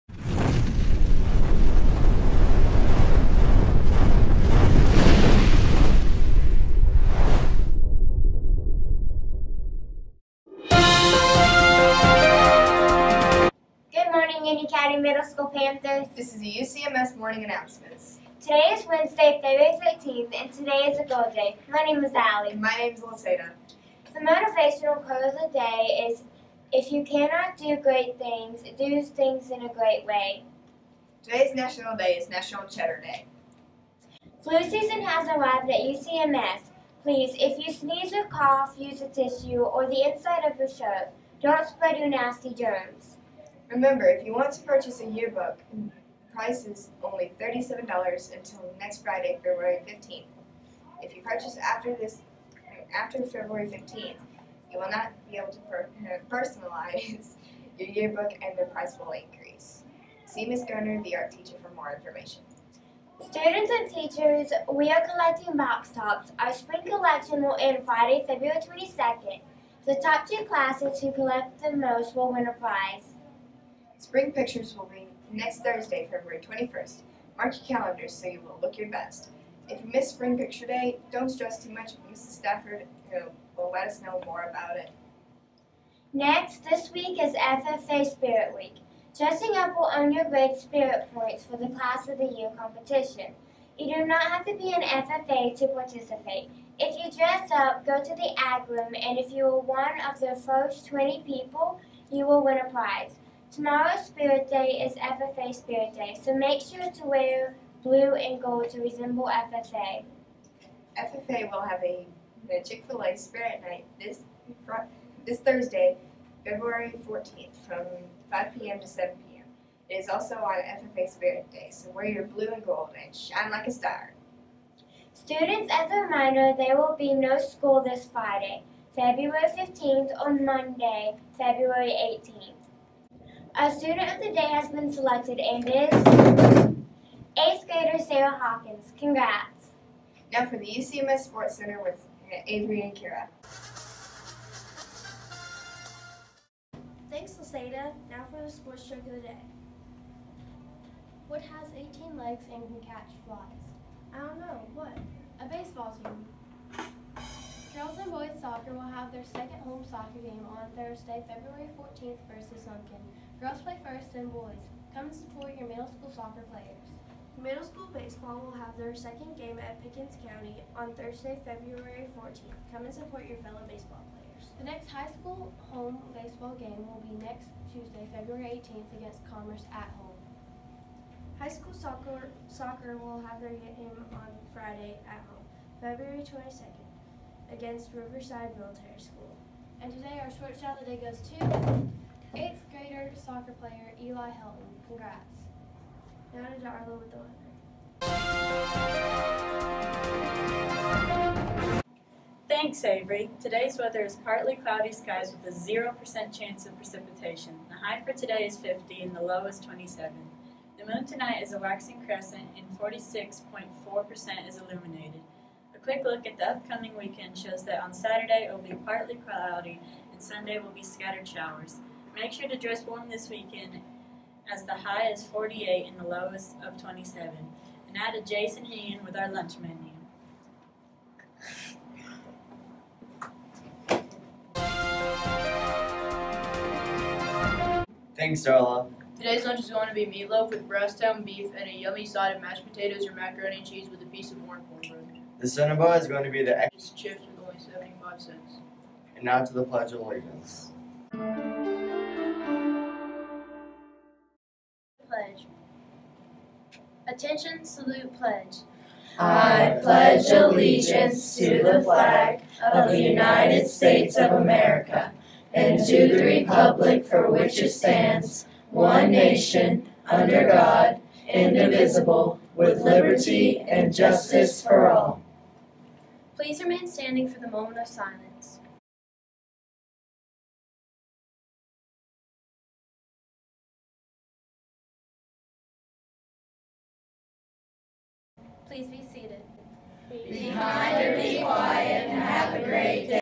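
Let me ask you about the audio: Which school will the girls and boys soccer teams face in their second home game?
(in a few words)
Lincoln.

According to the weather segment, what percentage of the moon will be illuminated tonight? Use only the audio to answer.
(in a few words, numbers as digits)
46.4%.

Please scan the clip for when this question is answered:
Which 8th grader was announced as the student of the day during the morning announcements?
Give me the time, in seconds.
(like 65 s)
137 s.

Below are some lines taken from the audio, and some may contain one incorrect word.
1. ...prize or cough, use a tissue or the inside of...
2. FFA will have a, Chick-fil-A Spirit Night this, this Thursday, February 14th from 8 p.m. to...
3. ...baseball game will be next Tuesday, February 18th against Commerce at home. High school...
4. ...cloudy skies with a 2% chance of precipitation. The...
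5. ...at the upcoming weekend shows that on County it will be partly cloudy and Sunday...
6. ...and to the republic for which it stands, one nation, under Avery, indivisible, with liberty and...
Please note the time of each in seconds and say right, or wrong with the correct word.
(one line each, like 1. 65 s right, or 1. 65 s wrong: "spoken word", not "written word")
1. 37 s wrong: "sneeze", not "prize"
2. 110 s wrong: "5", not "8"
3. 176 s right
4. 204 s wrong: "0", not "2"
5. 216 s wrong: "Saturday", not "County"
6. 265 s wrong: "God", not "Avery".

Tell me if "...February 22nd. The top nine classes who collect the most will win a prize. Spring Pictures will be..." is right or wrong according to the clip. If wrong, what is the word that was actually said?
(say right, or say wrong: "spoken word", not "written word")
wrong: "two", not "nine".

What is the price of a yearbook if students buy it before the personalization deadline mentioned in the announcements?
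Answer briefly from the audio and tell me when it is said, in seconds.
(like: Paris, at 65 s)
$37, at 47 s.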